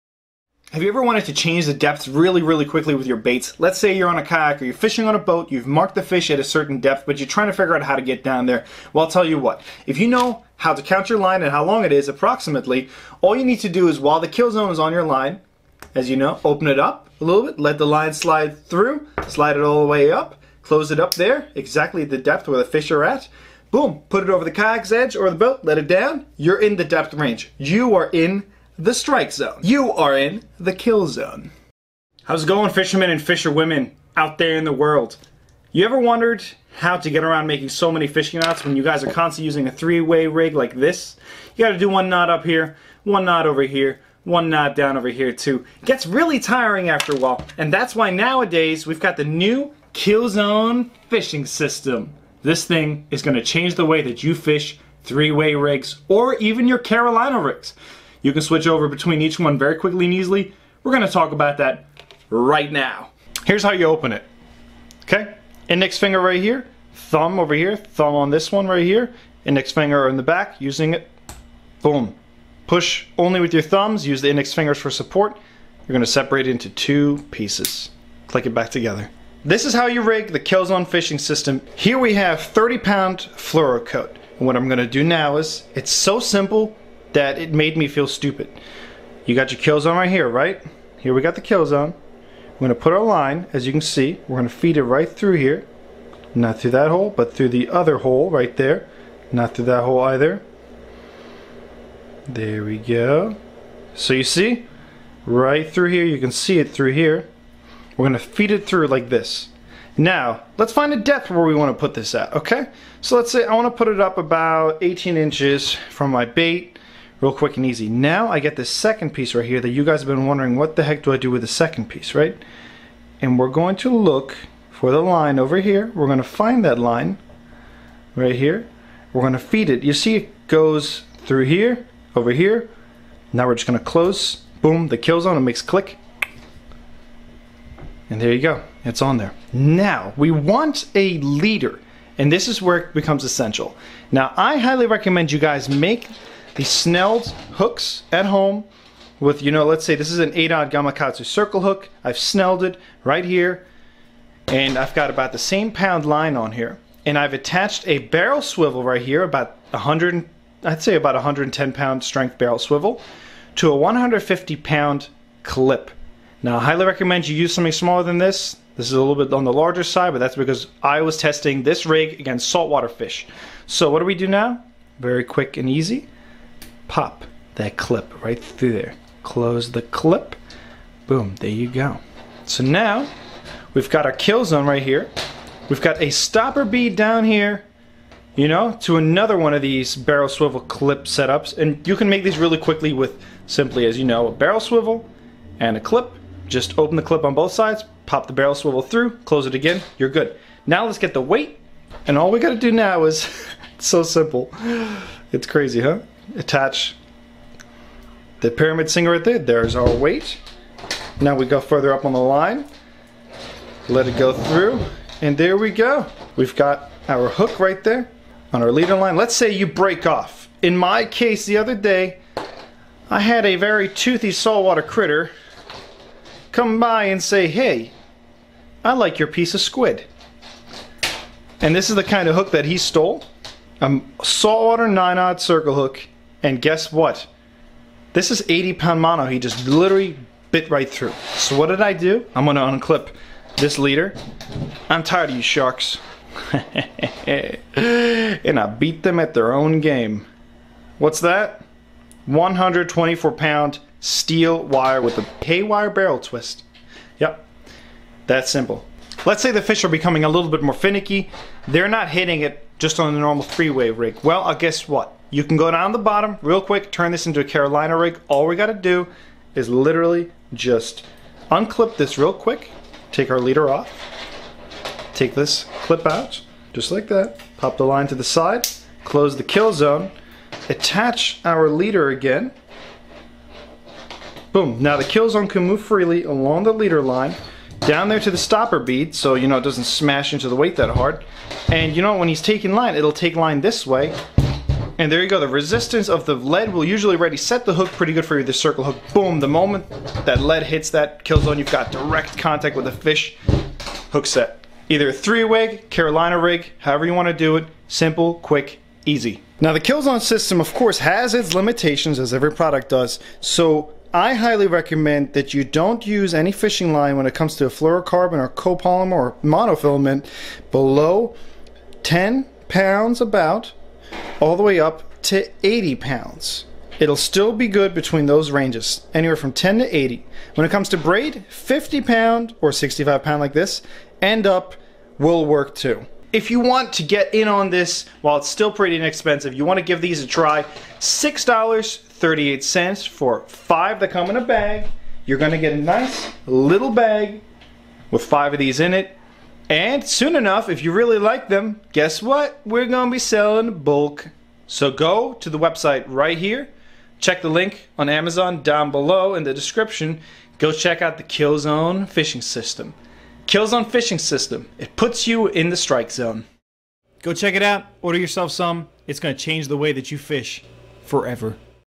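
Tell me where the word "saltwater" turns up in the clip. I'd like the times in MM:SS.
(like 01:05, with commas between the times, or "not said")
02:52, 03:44, 03:54.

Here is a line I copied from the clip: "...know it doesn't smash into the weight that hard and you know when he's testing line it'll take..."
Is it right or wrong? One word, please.
wrong.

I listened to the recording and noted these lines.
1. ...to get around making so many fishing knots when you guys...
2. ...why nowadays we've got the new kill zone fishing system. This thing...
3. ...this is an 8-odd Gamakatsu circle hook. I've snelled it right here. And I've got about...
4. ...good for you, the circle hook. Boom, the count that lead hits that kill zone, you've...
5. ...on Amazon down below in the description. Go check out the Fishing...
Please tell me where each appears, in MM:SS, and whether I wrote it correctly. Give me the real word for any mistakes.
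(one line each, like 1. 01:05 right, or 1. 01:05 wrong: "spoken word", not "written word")
1. 00:36 right
2. 00:47 right
3. 02:29 right
4. 04:58 wrong: "moment", not "count"
5. 05:57 wrong: "Killzone", not "Fishing".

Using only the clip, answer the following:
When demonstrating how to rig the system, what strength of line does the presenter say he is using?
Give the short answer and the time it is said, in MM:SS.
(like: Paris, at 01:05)
30 pound, at 01:22.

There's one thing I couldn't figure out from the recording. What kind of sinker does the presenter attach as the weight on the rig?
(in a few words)
Pyramid sinker.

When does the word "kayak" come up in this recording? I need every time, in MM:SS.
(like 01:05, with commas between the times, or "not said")
00:04, 00:24.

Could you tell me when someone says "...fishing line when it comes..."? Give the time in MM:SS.
05:16.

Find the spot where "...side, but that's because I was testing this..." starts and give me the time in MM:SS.
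02:49.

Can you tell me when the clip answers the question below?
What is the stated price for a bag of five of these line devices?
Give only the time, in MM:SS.
05:40.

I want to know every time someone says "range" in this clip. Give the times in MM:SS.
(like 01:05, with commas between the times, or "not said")
00:27, 05:28.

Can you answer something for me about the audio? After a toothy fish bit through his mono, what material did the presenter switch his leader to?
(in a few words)
Steel wire.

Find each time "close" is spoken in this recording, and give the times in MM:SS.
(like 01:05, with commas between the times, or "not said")
00:20, 02:13, 02:59, 03:19, 04:39.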